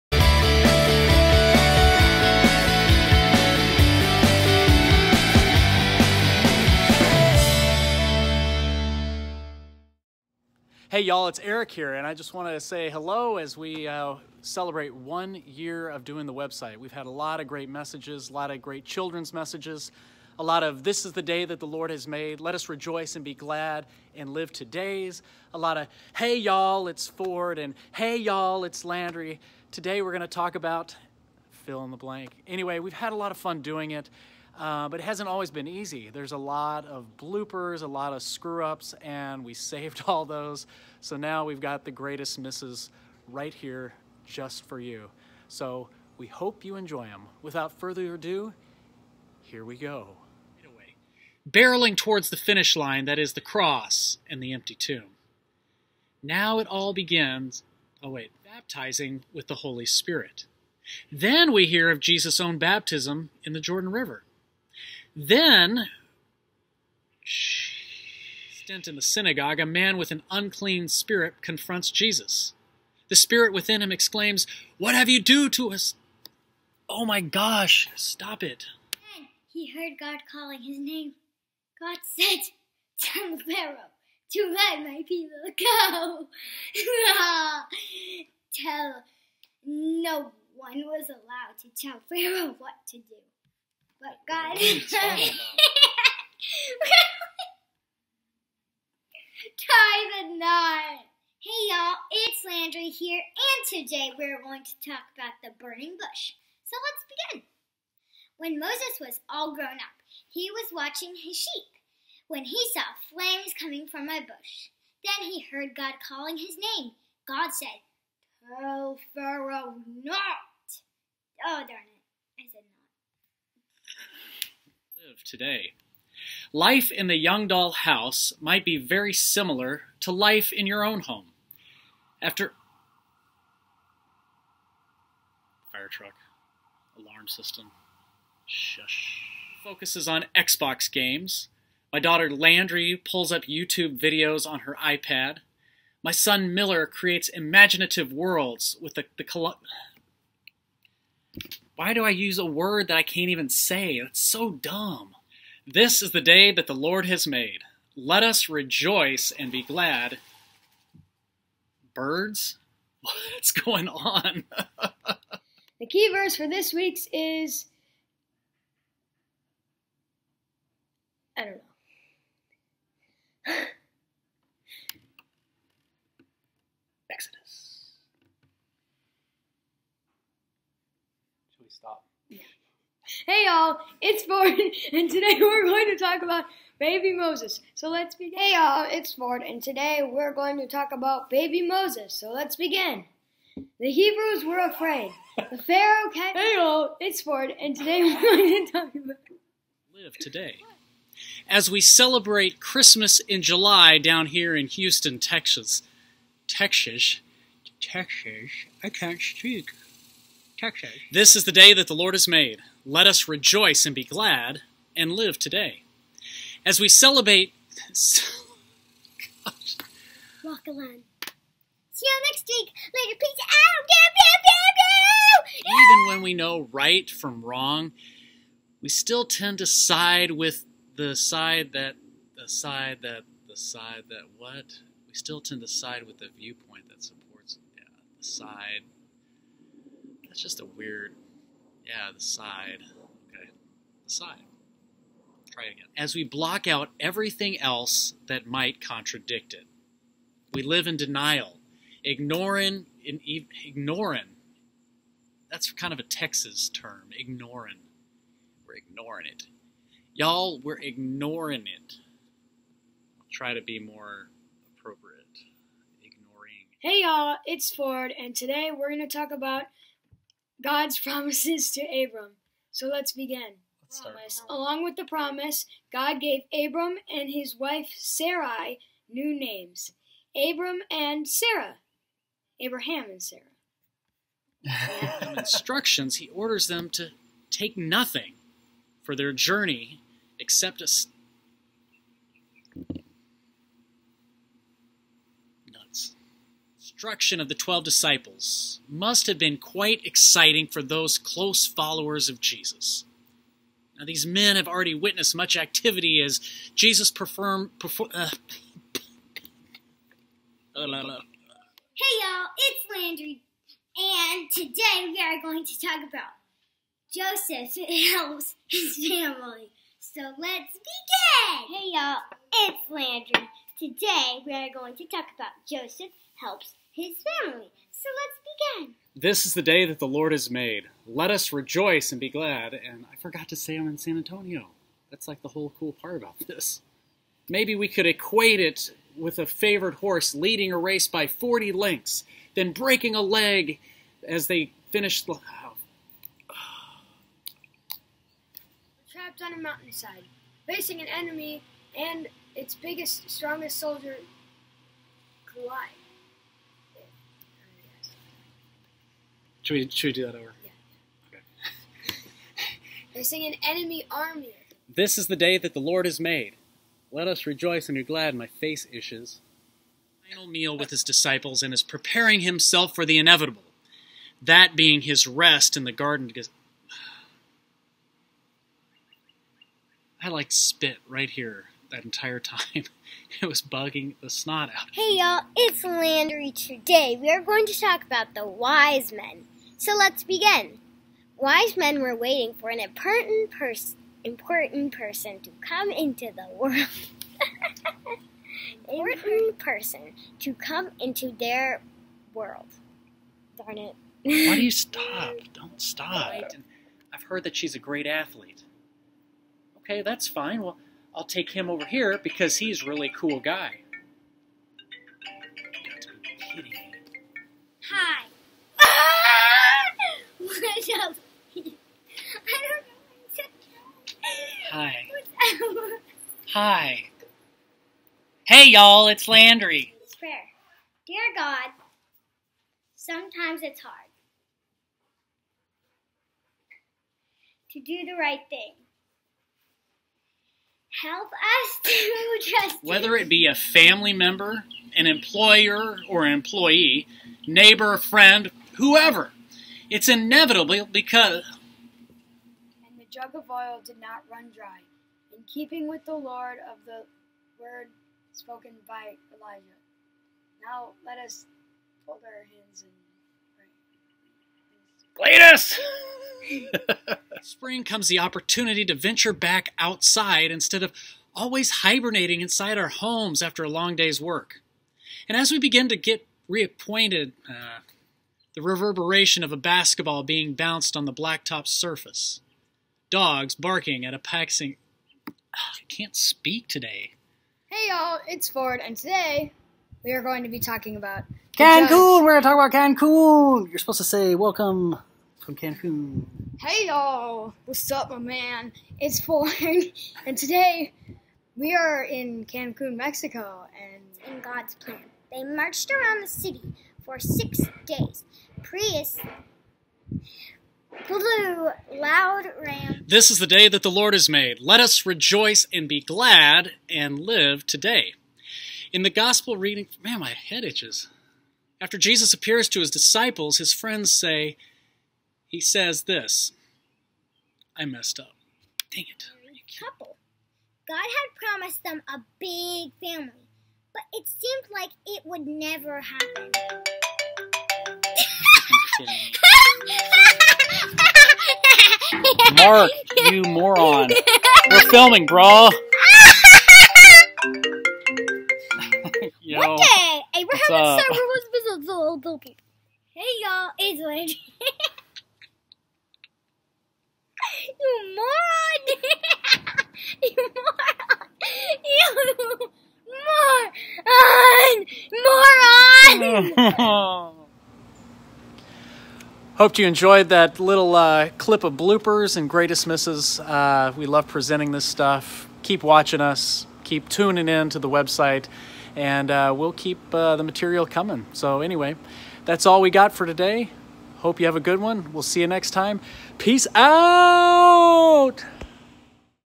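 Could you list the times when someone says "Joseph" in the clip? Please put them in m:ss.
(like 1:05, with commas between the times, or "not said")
5:17, 5:25.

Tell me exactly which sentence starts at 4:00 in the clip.
That's just a weird yeah, the side.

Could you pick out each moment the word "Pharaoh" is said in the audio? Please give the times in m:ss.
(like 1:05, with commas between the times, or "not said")
1:23, 1:32, 1:59, 3:15.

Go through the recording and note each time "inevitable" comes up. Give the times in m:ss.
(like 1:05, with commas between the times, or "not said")
6:13, 7:30.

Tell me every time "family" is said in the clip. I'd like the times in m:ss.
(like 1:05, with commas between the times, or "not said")
5:18, 5:27, 7:23, 8:53.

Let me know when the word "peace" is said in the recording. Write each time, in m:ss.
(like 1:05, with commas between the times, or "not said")
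3:43, 9:46.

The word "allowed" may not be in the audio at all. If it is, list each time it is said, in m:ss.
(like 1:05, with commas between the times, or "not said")
1:31.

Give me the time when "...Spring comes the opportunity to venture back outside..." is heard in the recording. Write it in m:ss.
7:47.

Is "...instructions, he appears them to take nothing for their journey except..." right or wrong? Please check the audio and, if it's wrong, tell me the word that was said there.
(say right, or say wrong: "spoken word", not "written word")
wrong: "orders", not "appears".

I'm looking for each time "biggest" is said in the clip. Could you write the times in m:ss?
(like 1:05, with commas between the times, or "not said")
5:52.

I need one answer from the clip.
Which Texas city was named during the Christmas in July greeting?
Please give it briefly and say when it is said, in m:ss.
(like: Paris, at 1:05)
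Houston, at 3:24.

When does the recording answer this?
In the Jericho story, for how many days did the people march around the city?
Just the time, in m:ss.
8:27.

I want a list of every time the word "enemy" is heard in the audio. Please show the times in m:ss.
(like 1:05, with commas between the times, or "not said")
5:51, 6:03.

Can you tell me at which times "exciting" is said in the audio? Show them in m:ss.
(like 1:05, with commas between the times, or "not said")
5:00.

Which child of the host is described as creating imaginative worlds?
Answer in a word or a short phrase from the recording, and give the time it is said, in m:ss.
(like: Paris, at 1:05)
Miller, at 2:26.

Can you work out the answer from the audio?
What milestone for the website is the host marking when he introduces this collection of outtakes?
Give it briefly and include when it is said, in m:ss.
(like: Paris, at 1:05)
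One year, at 0:14.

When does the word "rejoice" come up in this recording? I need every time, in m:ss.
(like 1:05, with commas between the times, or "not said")
0:22, 2:38, 3:33, 5:31, 6:07, 8:35.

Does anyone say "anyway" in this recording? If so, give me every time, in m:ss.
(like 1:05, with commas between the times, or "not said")
0:32, 9:41.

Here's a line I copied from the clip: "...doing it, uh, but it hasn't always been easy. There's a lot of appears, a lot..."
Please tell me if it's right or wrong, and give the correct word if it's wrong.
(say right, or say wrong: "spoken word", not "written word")
wrong: "bloopers", not "appears".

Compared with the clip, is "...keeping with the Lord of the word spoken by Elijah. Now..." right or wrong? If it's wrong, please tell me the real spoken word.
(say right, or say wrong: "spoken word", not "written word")
right.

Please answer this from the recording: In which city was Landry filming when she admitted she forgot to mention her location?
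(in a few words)
San Antonio.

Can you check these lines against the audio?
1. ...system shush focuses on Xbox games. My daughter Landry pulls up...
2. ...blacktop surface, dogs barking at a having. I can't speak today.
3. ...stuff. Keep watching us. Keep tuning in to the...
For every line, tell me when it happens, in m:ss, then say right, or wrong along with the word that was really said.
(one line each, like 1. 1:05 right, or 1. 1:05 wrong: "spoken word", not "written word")
1. 2:17 right
2. 8:01 wrong: "passing", not "having"
3. 9:34 right.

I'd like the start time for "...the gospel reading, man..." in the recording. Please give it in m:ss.
8:39.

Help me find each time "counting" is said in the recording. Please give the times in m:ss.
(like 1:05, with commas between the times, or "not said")
not said.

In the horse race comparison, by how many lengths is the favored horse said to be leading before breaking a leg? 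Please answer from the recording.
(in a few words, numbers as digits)
40.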